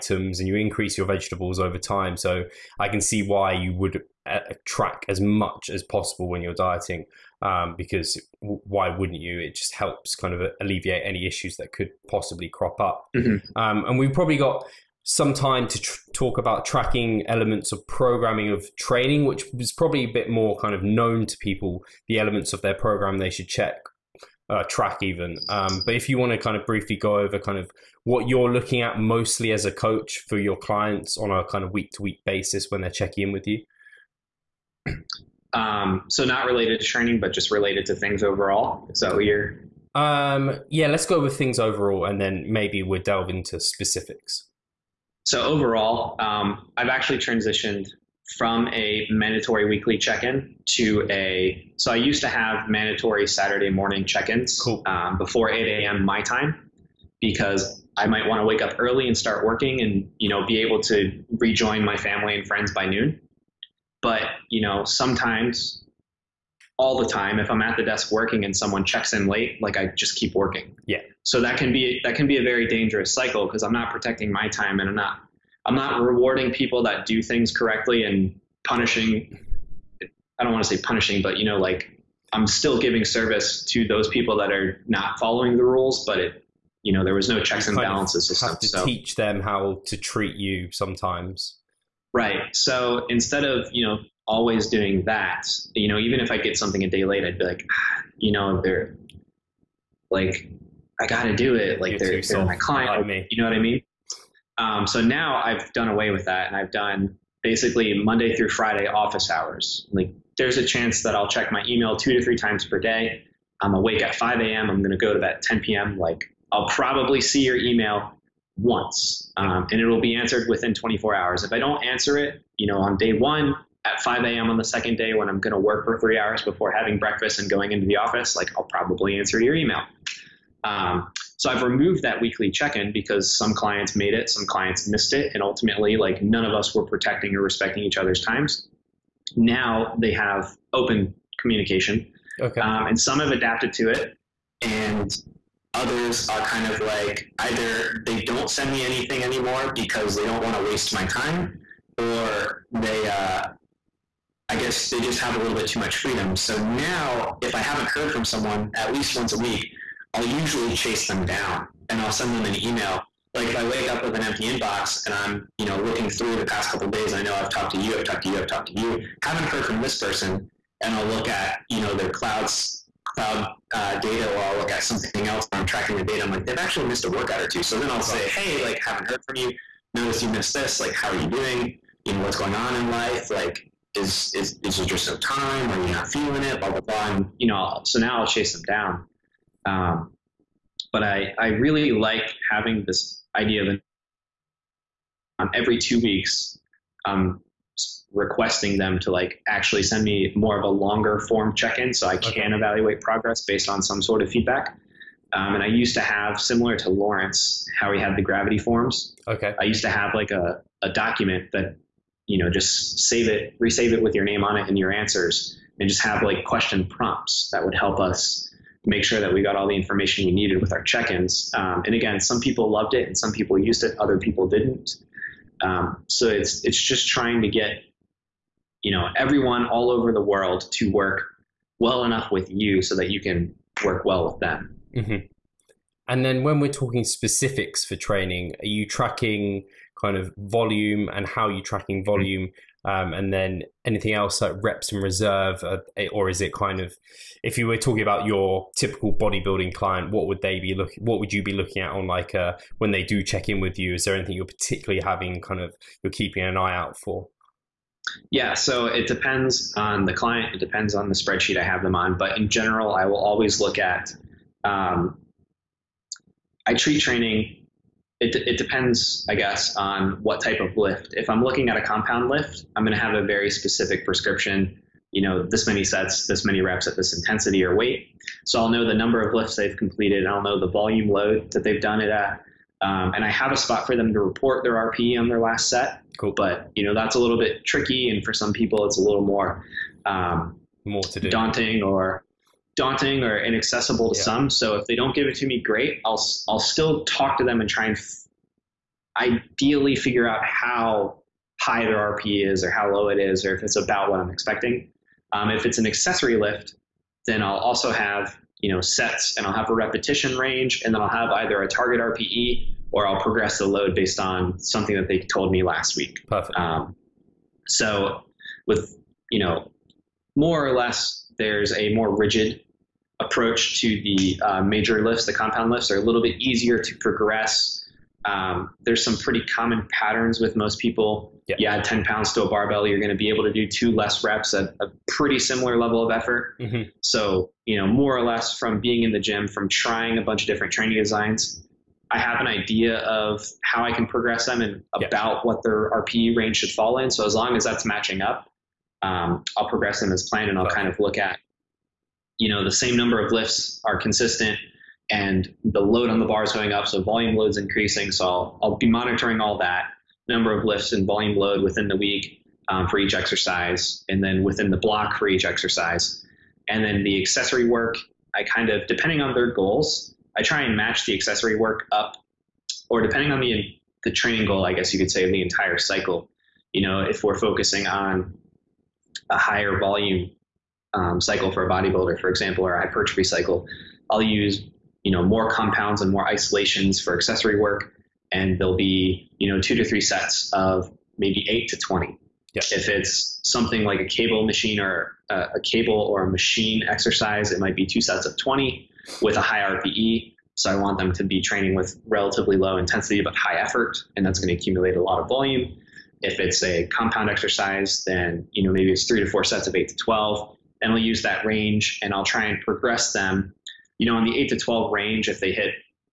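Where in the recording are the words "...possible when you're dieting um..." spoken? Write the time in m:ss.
0:05.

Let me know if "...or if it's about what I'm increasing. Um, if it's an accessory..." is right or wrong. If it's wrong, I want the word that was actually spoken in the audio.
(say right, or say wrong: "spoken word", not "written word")
wrong: "expecting", not "increasing".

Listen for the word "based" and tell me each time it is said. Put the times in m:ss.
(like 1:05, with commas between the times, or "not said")
3:23, 5:13.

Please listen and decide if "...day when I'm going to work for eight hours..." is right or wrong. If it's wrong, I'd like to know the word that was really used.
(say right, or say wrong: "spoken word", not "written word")
wrong: "three", not "eight".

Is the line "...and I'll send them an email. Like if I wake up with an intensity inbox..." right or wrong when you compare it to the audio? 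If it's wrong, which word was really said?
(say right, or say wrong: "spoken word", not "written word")
wrong: "empty", not "intensity".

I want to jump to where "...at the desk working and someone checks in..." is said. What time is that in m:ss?
1:07.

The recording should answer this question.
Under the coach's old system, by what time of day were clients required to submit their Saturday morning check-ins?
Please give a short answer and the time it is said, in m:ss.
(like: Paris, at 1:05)
8 a.m., at 0:55.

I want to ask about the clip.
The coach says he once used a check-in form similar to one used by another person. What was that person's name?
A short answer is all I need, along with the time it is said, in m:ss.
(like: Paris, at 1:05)
Lawrence, at 3:26.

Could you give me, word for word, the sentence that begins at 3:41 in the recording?
Um, and again, some people loved it and some people used it, other people didn't.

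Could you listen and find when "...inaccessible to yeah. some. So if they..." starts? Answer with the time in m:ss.
4:53.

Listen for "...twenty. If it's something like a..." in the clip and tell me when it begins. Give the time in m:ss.
6:31.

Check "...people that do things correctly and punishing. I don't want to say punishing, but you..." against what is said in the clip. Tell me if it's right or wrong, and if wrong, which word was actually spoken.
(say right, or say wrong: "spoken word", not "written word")
right.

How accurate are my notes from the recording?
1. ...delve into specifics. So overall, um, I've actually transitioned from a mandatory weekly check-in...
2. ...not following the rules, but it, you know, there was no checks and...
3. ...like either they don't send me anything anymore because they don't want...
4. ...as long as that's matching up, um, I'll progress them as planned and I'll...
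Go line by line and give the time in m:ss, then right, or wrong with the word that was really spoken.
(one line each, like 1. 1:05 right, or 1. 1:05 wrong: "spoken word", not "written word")
1. 0:43 right
2. 1:24 right
3. 2:26 right
4. 5:47 right.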